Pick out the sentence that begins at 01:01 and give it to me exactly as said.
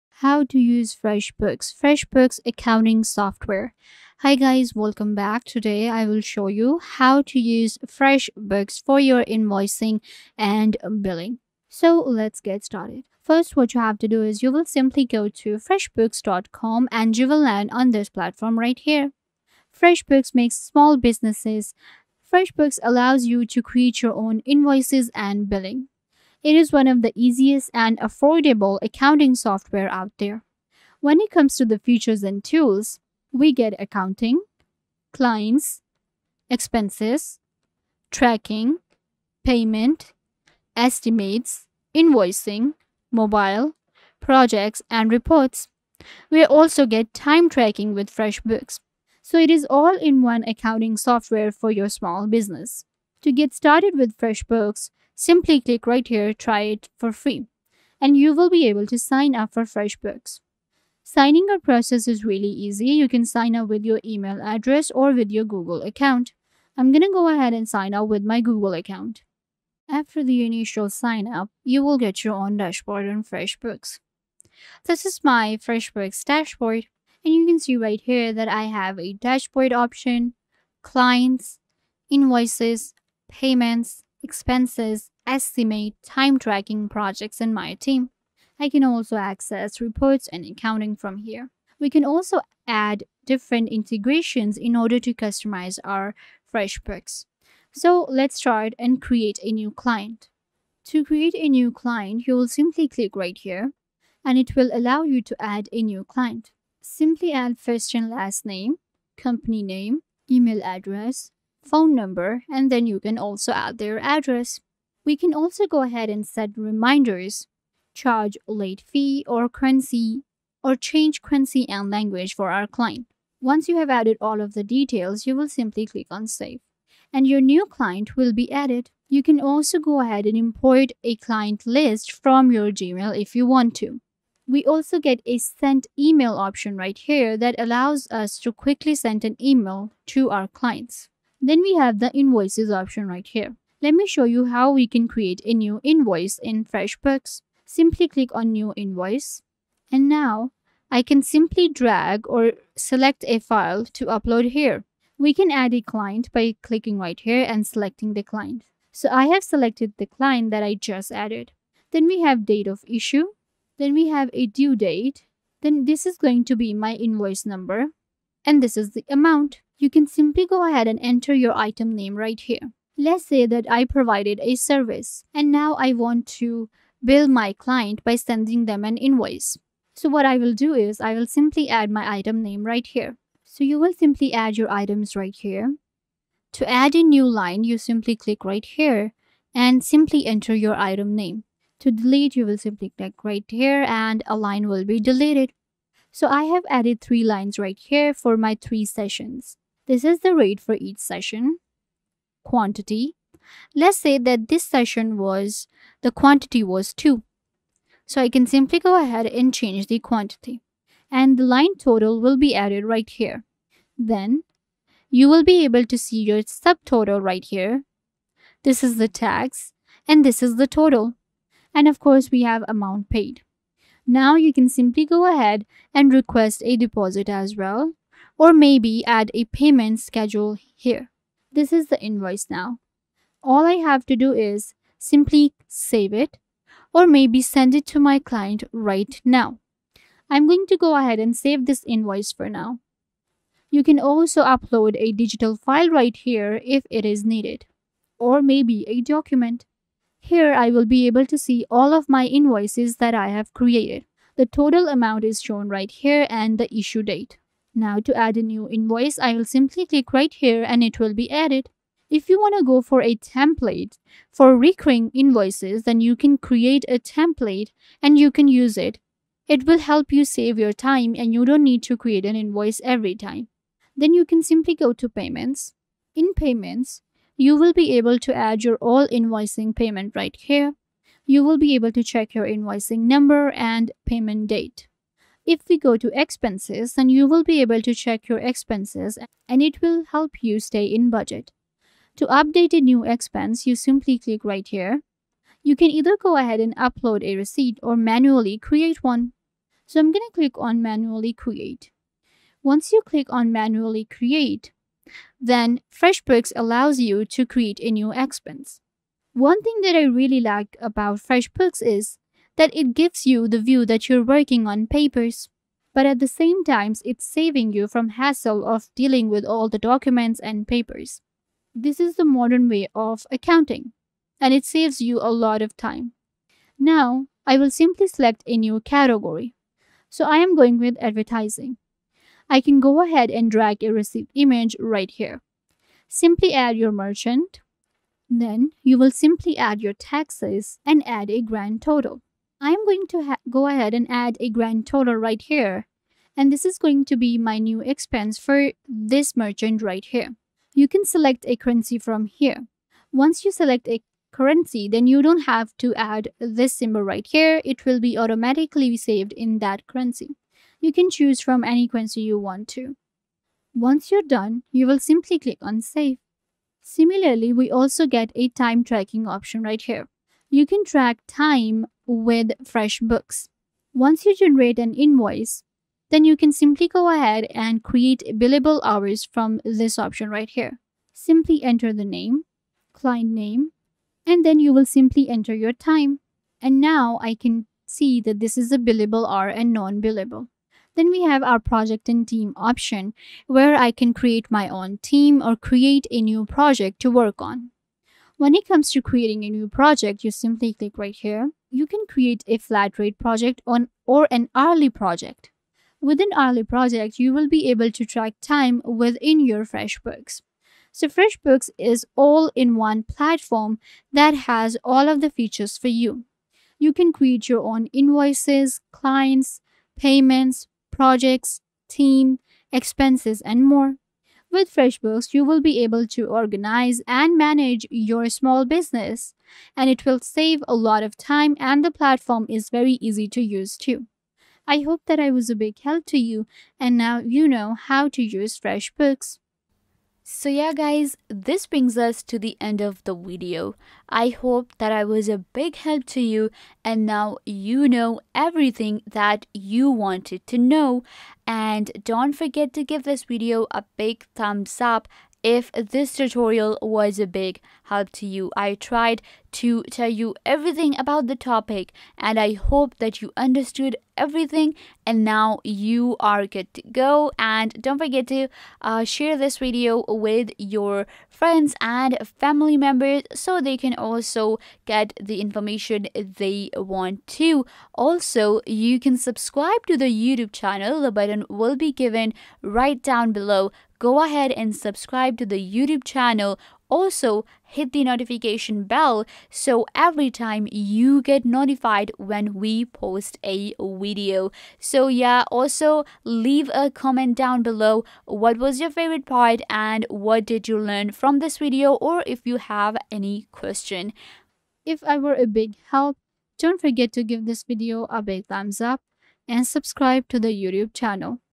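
Signing up process is really easy.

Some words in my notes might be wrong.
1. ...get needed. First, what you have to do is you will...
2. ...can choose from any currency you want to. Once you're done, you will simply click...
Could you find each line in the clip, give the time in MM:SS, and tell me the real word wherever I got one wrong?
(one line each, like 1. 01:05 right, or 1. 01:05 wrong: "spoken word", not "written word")
1. 00:12 wrong: "started", not "needed"
2. 06:00 right.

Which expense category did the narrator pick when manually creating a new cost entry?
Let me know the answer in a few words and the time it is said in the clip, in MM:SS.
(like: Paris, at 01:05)
Advertising, at 05:30.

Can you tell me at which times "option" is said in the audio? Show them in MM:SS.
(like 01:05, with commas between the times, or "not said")
01:19, 02:16, 02:22, 06:09, 06:19, 06:32.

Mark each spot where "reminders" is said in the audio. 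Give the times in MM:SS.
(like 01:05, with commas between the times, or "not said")
01:56.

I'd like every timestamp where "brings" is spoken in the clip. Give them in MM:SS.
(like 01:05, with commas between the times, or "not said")
07:21.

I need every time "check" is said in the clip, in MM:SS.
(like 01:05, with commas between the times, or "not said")
04:42, 04:47.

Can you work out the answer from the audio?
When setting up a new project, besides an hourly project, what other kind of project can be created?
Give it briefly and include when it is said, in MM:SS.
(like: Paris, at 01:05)
Flat rate project, at 06:42.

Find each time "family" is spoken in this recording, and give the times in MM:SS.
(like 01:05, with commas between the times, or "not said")
07:52.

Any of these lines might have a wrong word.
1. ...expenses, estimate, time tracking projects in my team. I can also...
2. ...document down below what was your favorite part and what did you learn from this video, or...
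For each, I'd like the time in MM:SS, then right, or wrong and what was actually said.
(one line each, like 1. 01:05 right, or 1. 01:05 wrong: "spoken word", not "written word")
1. 01:24 right
2. 08:16 wrong: "comment", not "document".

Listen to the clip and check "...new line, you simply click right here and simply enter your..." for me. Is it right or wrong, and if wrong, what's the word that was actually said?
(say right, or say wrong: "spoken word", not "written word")
right.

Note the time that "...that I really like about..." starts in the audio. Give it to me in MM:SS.
05:09.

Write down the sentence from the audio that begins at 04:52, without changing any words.
To update a new expense, you simply click right here.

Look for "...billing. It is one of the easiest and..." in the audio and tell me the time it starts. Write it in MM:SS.
00:25.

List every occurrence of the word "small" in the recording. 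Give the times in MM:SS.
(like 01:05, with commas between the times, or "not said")
00:20, 00:51, 07:08.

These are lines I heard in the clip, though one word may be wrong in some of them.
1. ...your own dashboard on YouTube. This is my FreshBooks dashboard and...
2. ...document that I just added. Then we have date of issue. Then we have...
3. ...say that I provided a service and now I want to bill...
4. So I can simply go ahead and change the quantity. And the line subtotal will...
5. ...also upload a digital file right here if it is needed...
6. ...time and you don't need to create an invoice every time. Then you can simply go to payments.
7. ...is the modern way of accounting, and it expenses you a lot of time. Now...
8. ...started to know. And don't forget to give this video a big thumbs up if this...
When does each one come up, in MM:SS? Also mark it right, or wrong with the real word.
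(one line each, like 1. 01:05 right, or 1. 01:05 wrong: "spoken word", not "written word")
1. 01:12 wrong: "FreshBooks", not "YouTube"
2. 02:40 wrong: "client", not "document"
3. 02:53 right
4. 03:28 wrong: "total", not "subtotal"
5. 04:03 right
6. 04:30 right
7. 05:21 wrong: "saves", not "expenses"
8. 07:29 wrong: "wanted", not "started".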